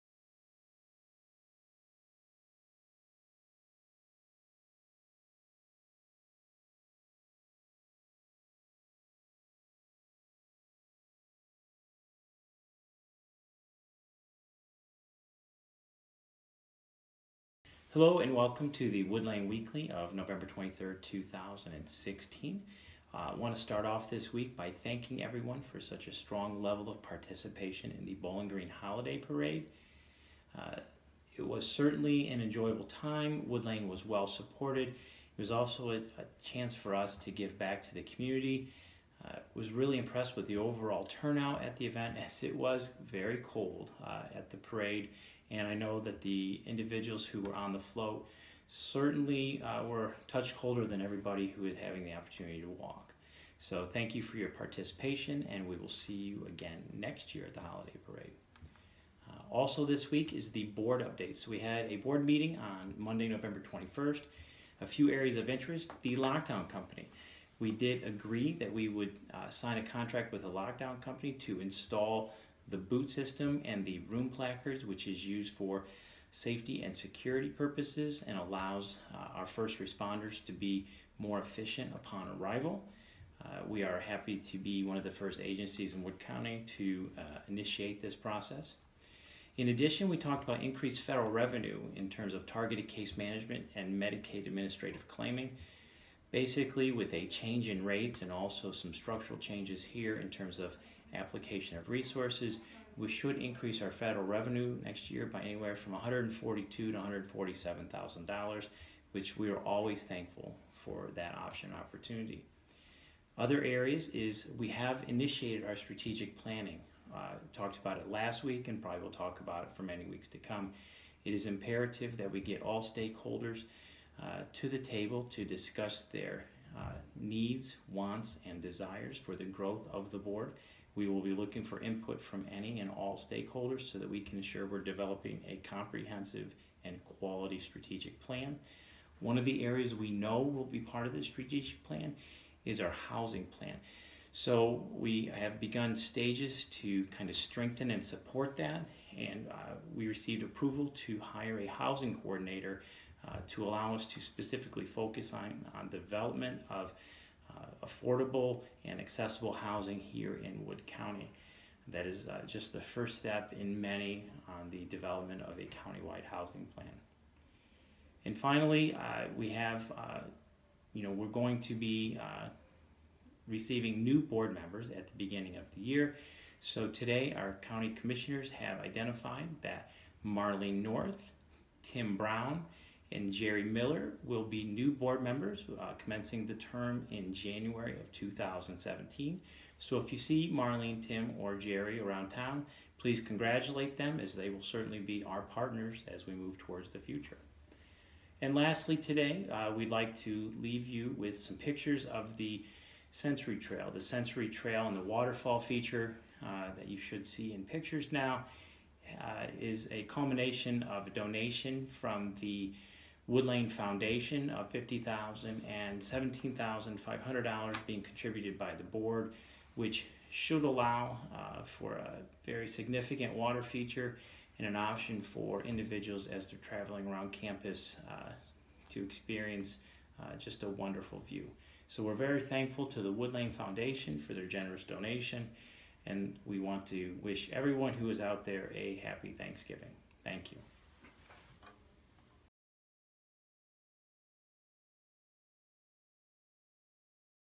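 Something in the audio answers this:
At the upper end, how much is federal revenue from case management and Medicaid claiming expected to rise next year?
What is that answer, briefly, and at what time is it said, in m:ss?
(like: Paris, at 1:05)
147 thousand dollars, at 1:46.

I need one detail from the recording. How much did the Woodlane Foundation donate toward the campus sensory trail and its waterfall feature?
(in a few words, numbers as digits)
$50,000.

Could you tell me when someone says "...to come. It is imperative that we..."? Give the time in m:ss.
2:00.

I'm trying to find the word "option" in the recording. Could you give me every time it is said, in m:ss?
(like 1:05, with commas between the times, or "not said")
1:51, 3:44.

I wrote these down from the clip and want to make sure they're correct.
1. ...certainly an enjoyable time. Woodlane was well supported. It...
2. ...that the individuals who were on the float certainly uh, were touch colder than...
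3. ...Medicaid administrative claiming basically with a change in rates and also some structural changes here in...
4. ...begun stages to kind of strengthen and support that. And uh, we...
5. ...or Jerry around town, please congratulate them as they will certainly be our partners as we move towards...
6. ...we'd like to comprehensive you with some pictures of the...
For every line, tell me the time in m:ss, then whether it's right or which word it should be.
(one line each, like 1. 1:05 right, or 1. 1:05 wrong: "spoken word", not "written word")
1. 0:31 right
2. 0:45 right
3. 1:34 right
4. 2:25 right
5. 3:11 right
6. 3:19 wrong: "leave", not "comprehensive".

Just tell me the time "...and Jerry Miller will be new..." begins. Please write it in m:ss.
3:03.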